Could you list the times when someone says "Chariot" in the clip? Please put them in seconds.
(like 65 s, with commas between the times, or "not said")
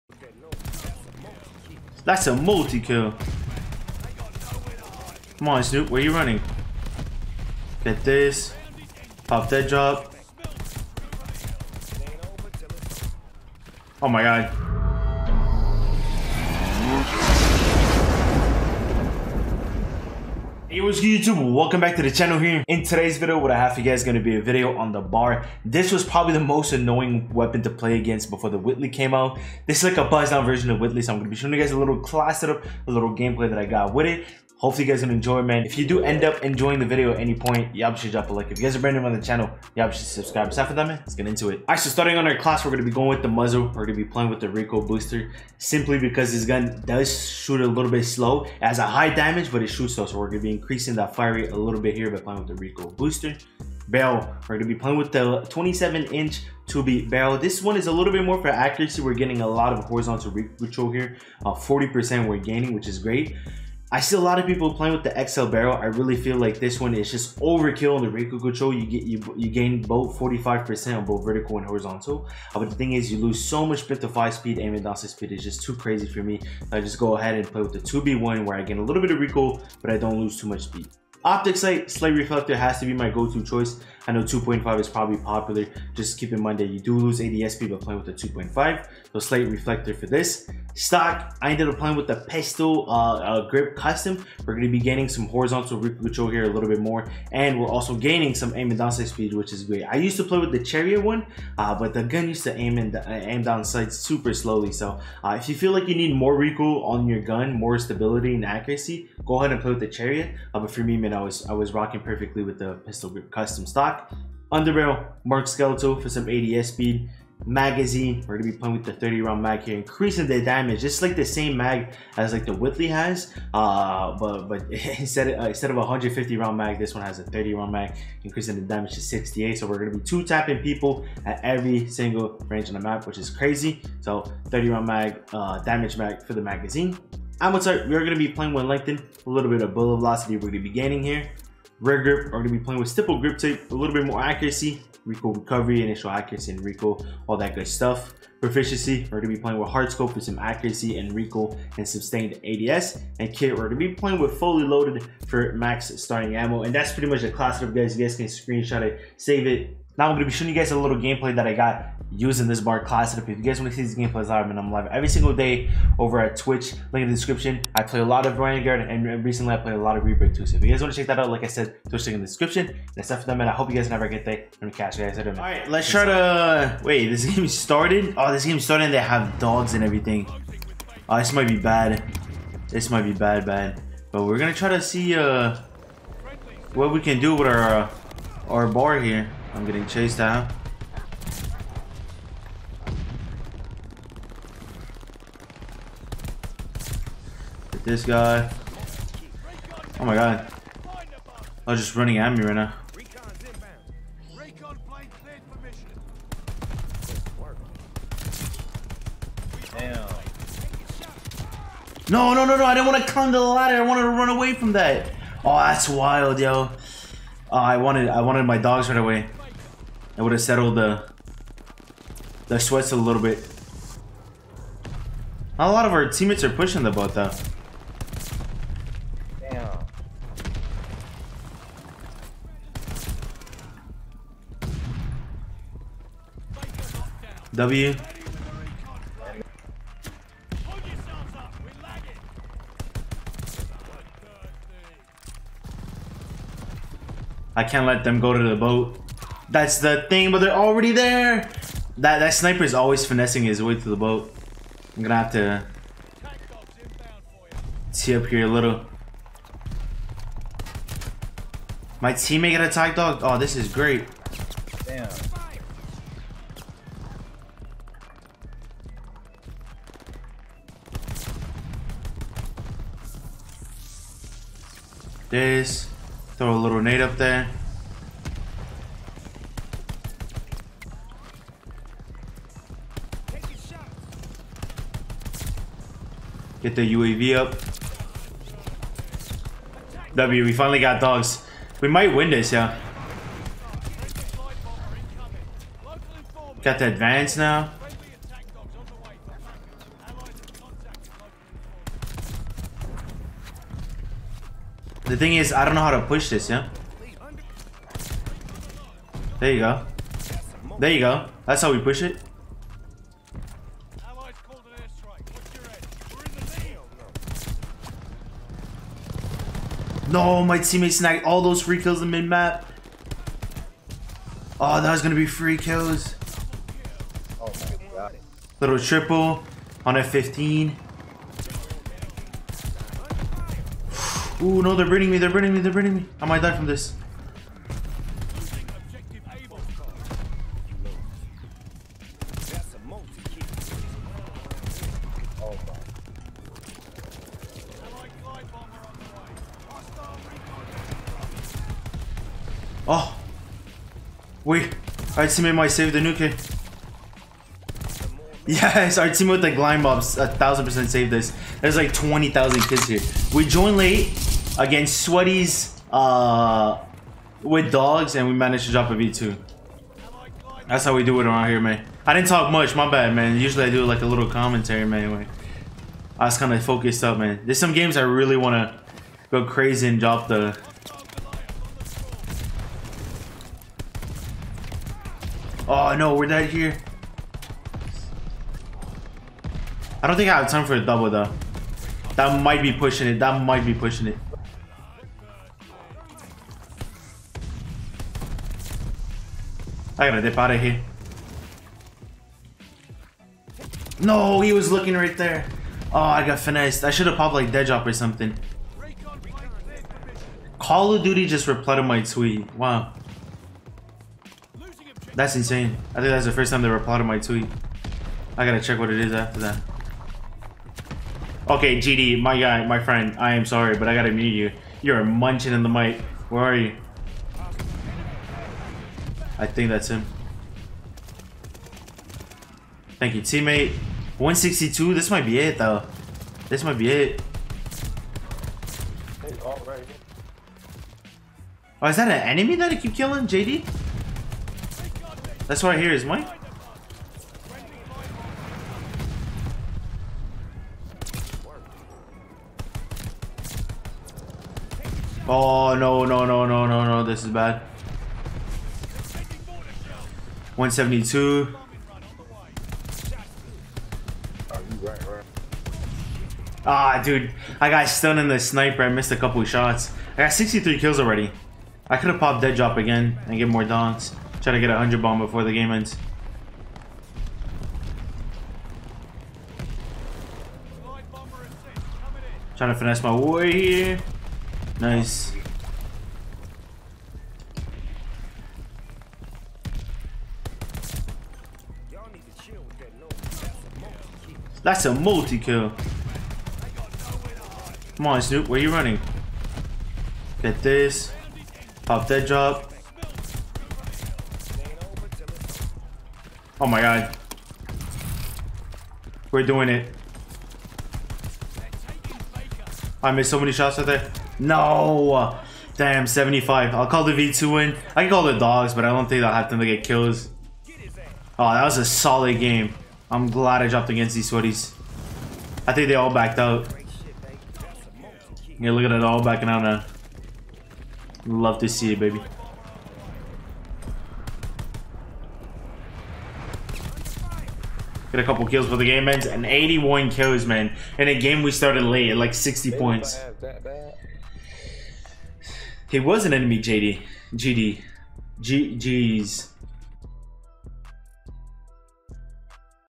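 100 s, 109 s.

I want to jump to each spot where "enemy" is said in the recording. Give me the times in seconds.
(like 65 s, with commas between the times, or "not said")
442 s, 546 s.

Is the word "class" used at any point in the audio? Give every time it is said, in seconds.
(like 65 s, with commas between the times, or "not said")
31 s, 42 s, 157 s, 162 s.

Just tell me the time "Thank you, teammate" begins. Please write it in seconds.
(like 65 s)
432 s.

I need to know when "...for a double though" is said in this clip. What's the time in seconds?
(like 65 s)
390 s.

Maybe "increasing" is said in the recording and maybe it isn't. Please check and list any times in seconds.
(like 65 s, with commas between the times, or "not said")
50 s, 119 s, 128 s.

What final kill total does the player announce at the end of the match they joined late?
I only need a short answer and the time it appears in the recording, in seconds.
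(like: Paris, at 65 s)
81, at 539 s.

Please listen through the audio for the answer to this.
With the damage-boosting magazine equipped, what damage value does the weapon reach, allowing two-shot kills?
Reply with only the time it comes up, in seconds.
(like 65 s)
129 s.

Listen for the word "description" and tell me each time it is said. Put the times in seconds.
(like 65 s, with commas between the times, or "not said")
167 s, 172 s.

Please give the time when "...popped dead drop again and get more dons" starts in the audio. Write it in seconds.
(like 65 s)
472 s.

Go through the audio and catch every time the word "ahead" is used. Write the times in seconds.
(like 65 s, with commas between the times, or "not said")
77 s, 109 s.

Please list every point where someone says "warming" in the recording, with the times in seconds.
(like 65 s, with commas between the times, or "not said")
not said.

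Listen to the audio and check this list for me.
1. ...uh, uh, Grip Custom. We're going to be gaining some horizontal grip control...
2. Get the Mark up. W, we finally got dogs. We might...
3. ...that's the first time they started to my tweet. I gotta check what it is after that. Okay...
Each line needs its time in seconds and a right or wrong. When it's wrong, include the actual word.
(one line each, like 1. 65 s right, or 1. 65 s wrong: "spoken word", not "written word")
1. 92 s right
2. 286 s wrong: "UAV", not "Mark"
3. 416 s wrong: "replied", not "started".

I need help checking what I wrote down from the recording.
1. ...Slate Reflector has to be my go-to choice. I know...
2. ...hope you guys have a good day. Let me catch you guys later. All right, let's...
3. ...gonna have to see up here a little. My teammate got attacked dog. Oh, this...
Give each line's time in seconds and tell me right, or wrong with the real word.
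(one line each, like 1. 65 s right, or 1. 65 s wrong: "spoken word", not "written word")
1. 81 s right
2. 173 s right
3. 255 s right.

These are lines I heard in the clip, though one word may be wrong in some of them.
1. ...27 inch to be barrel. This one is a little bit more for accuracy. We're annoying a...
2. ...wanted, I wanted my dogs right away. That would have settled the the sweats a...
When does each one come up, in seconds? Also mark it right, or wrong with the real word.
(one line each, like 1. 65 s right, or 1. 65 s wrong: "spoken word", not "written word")
1. 55 s wrong: "getting", not "annoying"
2. 217 s right.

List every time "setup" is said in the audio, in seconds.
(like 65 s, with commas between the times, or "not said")
32 s, 163 s.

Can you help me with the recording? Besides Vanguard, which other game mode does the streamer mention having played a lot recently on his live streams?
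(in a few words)
Rebirth.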